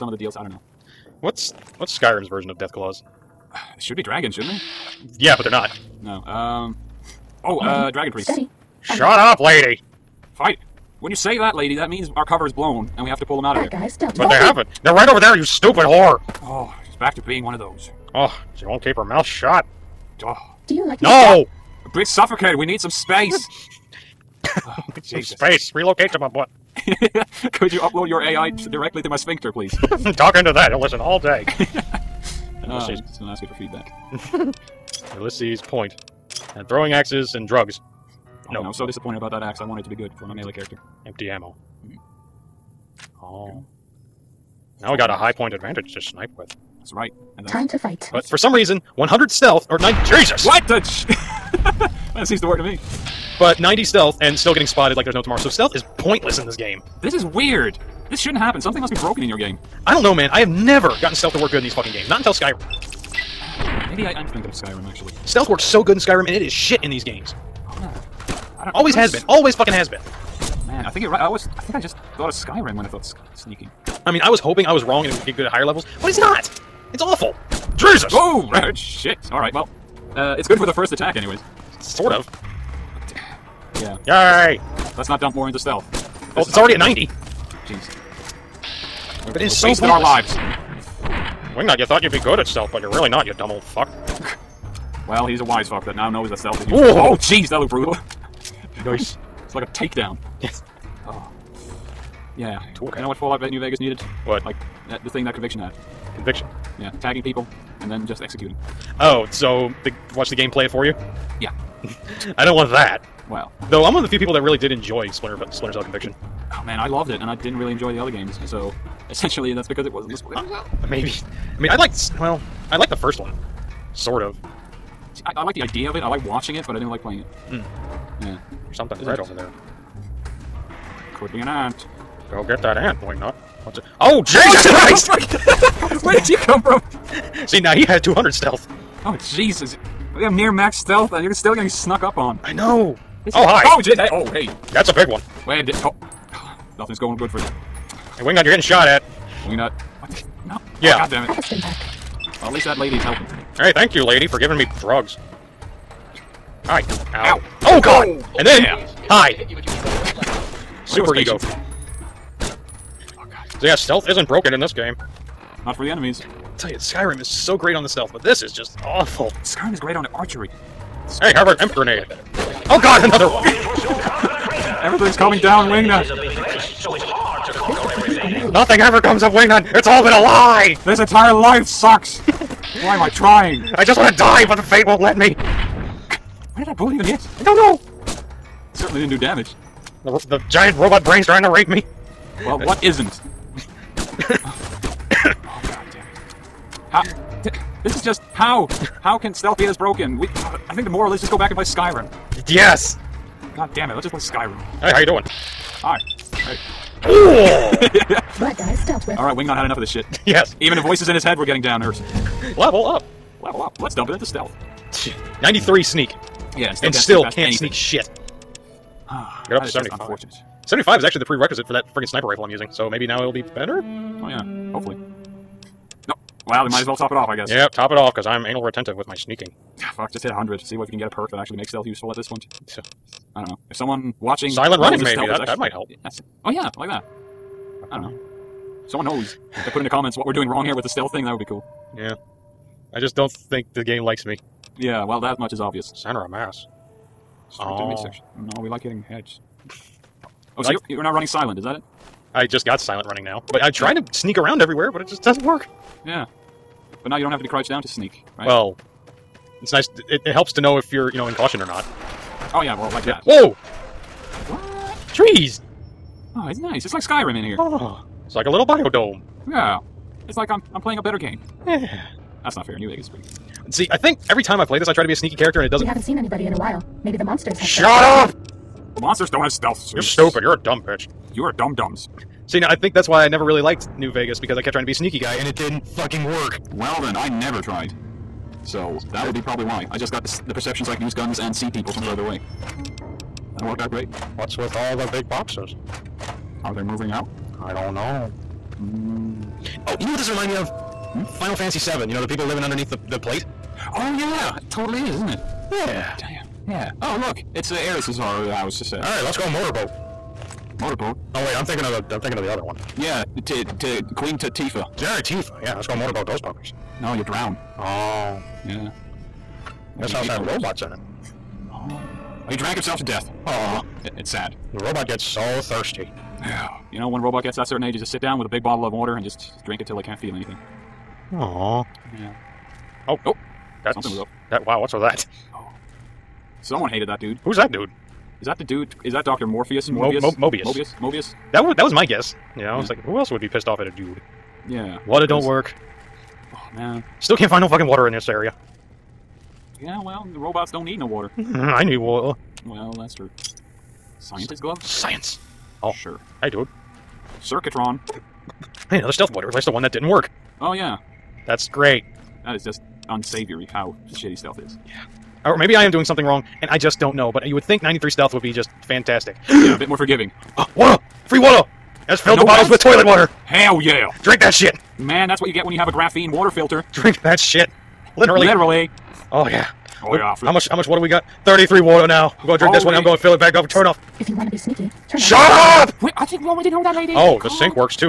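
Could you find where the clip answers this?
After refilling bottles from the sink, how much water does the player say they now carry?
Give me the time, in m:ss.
6:21.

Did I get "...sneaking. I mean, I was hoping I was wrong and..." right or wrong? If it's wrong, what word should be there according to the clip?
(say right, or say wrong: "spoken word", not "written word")
right.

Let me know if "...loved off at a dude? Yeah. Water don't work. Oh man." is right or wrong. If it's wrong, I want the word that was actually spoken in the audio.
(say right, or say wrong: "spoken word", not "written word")
wrong: "pissed", not "loved".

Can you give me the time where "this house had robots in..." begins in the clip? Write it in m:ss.
5:19.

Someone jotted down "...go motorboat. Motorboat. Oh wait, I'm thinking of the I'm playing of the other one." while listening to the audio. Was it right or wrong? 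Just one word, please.
wrong.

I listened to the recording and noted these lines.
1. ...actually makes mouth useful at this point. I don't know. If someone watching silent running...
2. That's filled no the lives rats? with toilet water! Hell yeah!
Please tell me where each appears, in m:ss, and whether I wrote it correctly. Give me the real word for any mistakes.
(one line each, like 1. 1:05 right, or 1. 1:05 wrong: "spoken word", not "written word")
1. 3:51 wrong: "stealth", not "mouth"
2. 6:12 wrong: "bottles", not "lives".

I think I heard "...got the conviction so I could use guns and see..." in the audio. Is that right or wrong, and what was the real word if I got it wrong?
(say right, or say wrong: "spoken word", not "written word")
wrong: "perception", not "conviction".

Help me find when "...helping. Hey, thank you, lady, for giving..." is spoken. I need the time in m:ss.
2:33.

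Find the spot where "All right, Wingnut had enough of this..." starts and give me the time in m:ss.
3:29.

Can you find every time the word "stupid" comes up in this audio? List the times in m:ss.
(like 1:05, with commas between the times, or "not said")
0:15, 4:40.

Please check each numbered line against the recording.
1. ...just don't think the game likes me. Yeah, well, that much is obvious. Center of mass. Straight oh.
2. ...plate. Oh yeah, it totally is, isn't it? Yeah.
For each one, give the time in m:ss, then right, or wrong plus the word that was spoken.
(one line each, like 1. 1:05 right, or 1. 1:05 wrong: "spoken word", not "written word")
1. 4:03 right
2. 5:03 right.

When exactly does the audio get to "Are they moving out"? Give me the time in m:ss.
4:56.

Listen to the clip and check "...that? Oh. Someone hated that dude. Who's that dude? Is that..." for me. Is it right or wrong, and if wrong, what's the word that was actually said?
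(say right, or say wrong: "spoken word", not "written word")
right.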